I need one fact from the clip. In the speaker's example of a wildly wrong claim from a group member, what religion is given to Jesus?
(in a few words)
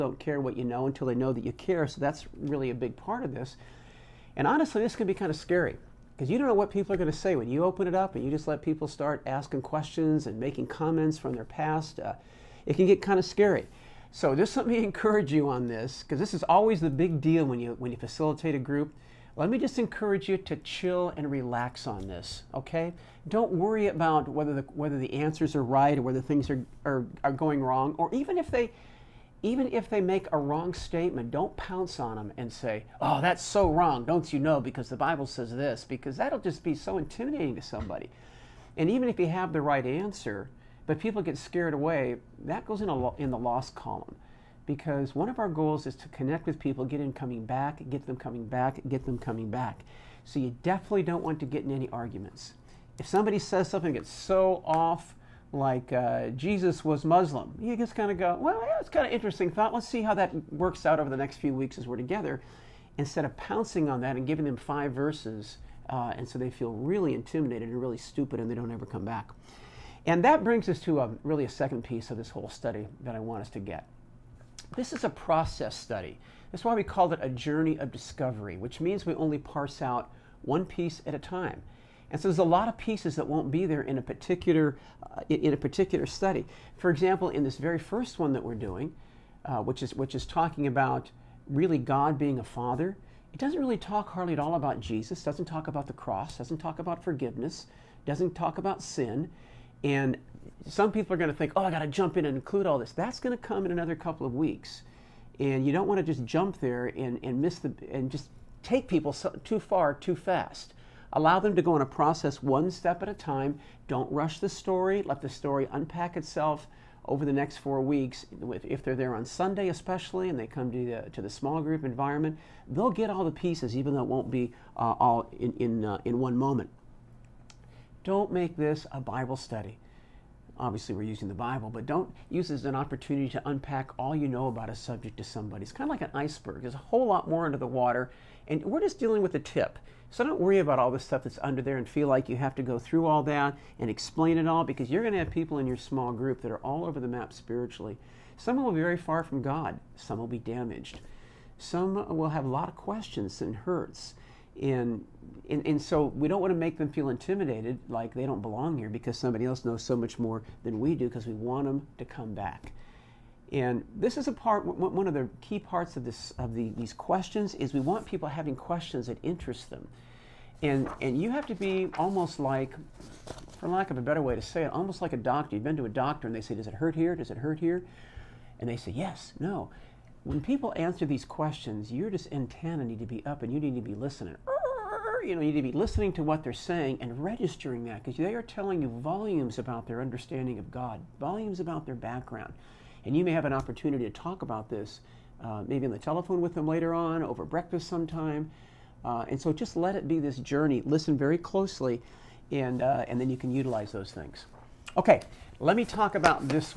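Muslim.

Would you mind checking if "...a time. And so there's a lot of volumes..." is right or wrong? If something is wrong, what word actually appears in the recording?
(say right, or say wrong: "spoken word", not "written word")
wrong: "pieces", not "volumes".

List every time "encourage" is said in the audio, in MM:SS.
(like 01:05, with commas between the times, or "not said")
00:14, 00:19.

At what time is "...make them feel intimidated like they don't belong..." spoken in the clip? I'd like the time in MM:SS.
02:36.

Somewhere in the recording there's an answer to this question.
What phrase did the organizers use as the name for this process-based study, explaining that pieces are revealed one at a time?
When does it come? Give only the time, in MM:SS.
01:17.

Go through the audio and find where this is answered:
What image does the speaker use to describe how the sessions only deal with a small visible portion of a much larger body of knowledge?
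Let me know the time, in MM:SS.
02:16.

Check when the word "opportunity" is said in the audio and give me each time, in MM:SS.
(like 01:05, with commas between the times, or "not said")
02:12, 03:13.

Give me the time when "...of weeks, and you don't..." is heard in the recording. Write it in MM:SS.
01:44.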